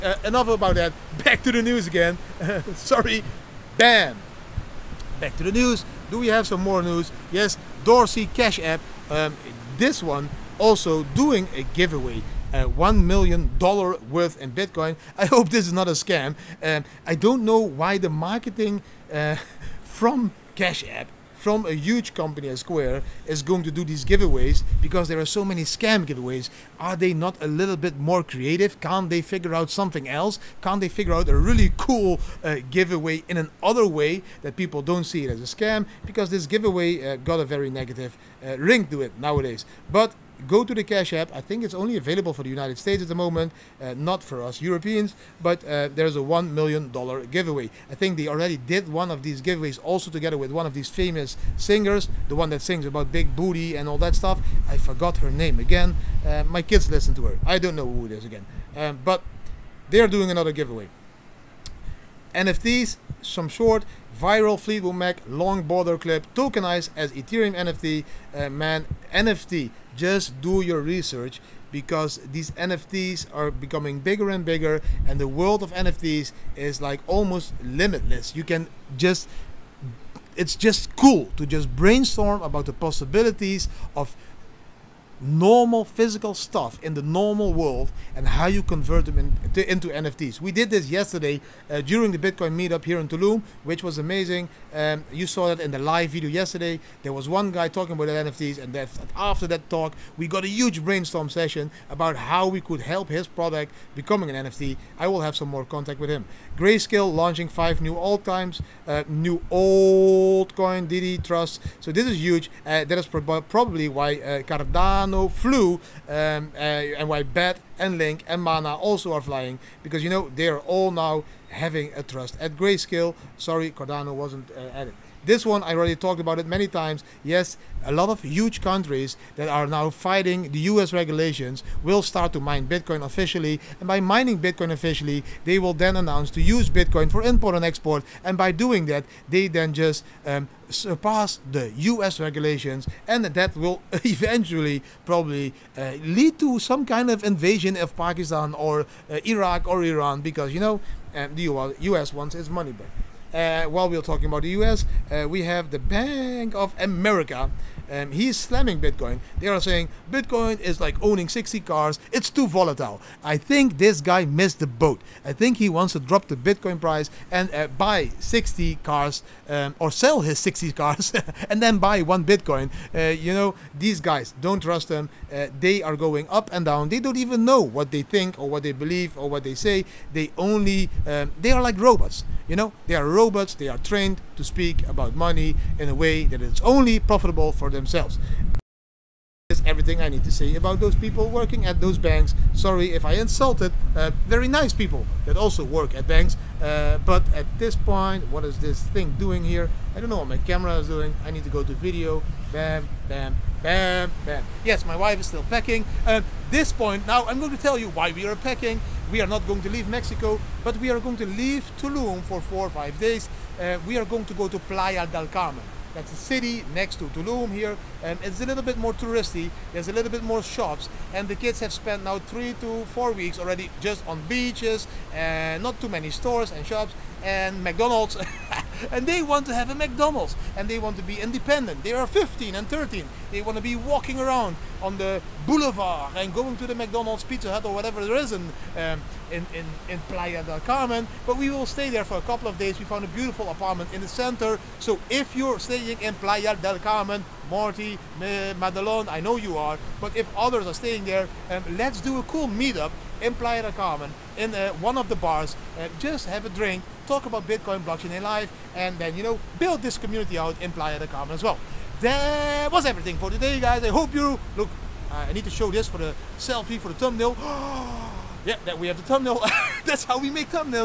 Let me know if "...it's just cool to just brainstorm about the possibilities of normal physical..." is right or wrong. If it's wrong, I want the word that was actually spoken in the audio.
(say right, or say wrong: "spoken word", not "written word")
right.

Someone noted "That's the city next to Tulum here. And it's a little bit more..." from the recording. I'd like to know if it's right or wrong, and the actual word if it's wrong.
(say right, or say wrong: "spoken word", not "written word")
right.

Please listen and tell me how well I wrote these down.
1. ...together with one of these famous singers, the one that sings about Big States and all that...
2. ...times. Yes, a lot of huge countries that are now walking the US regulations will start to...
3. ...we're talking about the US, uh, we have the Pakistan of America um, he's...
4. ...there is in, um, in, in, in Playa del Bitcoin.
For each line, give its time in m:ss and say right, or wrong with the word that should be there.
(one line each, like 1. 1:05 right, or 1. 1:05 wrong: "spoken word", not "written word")
1. 0:50 wrong: "Booty", not "States"
2. 2:06 wrong: "fighting", not "walking"
3. 2:33 wrong: "Bank", not "Pakistan"
4. 3:58 wrong: "Carmen", not "Bitcoin".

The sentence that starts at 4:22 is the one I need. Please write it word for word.
That was everything for today, guys.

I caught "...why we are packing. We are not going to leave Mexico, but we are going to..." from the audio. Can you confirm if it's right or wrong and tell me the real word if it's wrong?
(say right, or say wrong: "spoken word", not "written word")
right.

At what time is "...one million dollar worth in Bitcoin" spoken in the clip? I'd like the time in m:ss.
0:12.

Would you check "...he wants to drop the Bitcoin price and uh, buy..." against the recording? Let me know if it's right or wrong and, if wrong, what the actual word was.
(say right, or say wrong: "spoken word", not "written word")
right.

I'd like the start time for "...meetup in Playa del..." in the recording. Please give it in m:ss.
4:12.